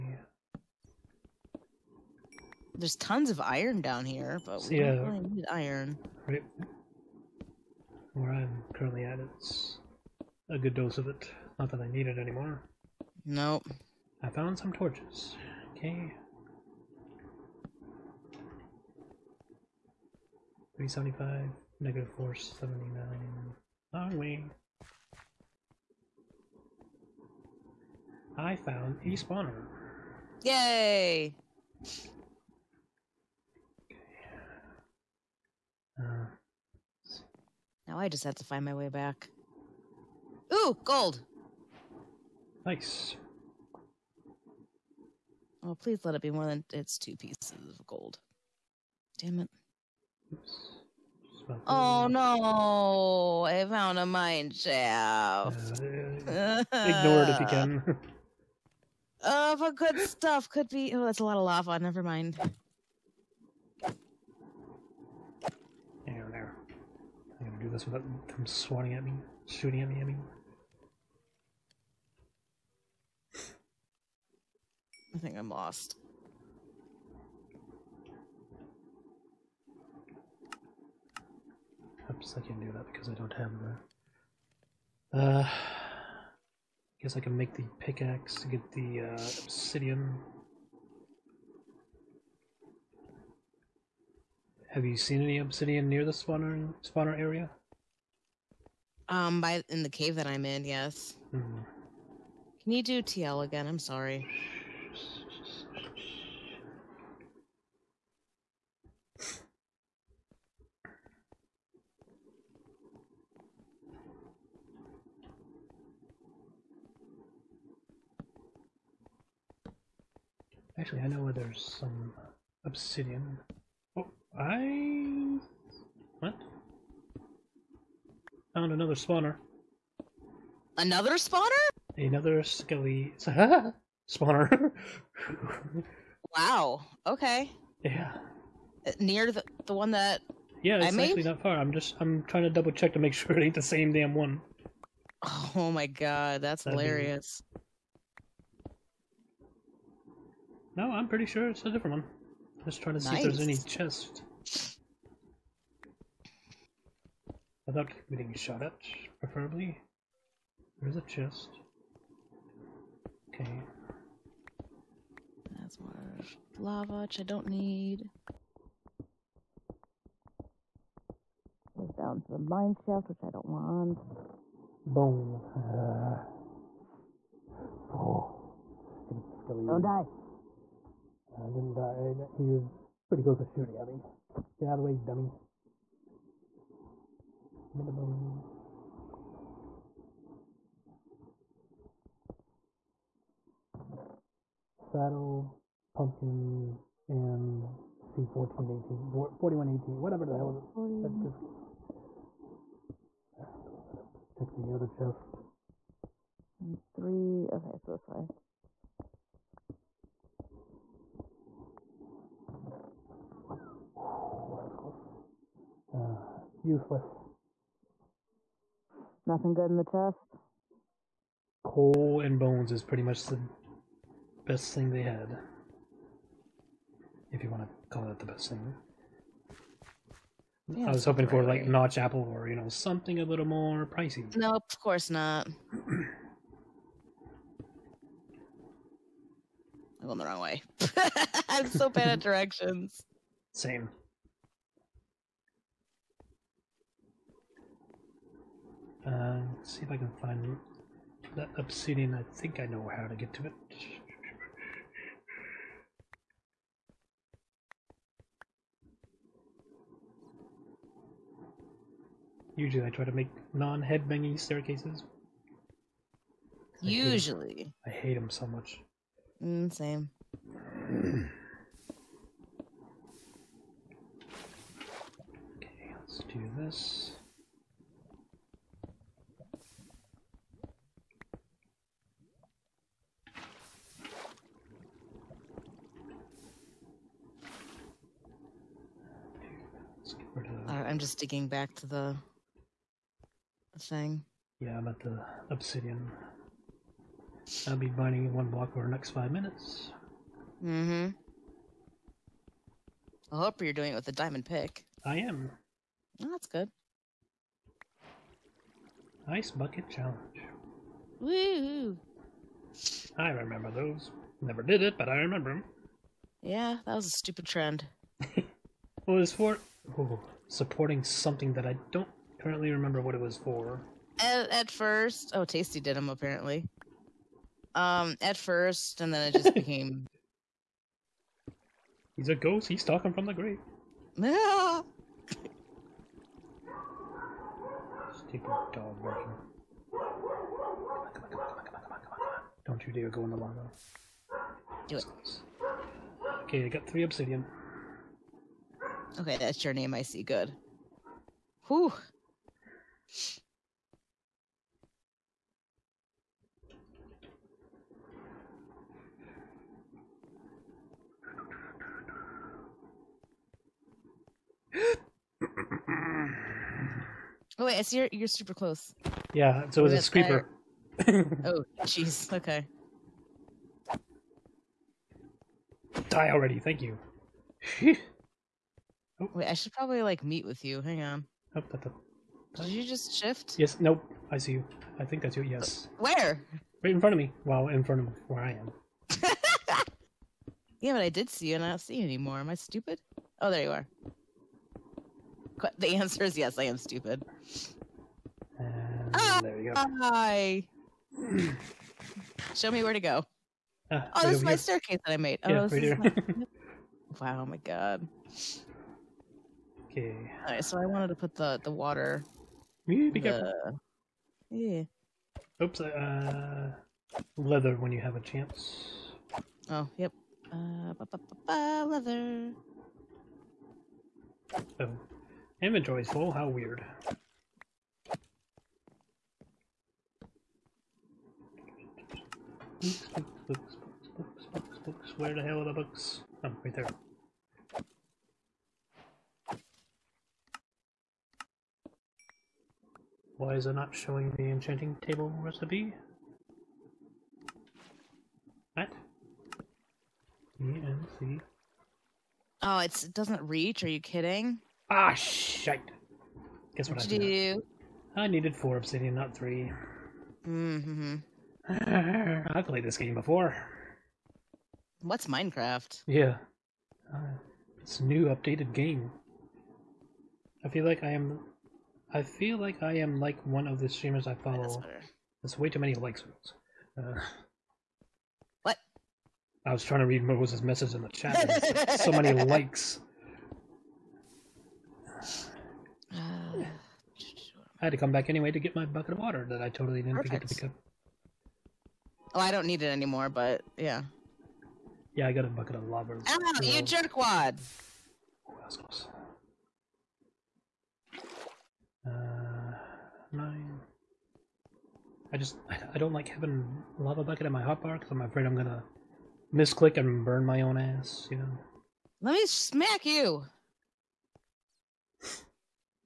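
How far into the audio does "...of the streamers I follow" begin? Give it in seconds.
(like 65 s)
473 s.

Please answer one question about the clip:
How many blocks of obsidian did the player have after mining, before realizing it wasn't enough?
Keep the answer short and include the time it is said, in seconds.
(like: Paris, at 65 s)
3, at 346 s.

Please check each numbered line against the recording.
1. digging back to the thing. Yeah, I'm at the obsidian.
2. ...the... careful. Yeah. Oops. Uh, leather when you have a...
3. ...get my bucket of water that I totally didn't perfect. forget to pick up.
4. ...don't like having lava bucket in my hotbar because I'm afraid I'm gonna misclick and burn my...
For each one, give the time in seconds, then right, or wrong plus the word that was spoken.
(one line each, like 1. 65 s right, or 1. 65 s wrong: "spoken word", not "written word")
1. 291 s right
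2. 413 s right
3. 488 s right
4. 505 s right.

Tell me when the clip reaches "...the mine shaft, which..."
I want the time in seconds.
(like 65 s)
172 s.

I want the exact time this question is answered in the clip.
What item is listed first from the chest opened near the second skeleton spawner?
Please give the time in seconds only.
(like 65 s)
194 s.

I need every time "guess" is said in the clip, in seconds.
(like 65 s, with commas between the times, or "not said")
87 s, 456 s.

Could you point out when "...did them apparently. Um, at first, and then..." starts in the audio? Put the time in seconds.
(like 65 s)
325 s.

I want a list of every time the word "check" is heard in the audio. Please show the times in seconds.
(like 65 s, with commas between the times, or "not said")
142 s, 204 s.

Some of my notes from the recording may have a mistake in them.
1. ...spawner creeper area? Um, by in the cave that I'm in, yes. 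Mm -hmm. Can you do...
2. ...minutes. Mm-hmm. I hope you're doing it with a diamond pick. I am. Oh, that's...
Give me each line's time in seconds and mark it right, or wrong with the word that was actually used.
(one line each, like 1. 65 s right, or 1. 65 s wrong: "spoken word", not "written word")
1. 96 s wrong: "spawner", not "creeper"
2. 299 s right.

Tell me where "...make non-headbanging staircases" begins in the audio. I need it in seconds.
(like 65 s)
263 s.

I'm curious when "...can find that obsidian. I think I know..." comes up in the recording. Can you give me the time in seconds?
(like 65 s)
249 s.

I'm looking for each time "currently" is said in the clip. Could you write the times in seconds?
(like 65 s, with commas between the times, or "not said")
8 s, 322 s.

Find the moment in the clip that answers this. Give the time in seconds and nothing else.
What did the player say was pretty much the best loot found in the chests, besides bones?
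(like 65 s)
221 s.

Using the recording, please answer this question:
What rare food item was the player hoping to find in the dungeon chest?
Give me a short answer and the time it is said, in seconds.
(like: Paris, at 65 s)
notch apple, at 231 s.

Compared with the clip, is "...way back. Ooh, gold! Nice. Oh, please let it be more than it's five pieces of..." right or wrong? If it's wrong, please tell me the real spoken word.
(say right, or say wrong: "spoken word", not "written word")
wrong: "two", not "five".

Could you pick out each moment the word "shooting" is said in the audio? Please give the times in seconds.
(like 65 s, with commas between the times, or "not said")
69 s, 183 s.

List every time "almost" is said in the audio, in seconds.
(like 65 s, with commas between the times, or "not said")
not said.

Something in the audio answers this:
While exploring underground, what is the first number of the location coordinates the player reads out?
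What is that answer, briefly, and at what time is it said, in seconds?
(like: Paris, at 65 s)
375, at 20 s.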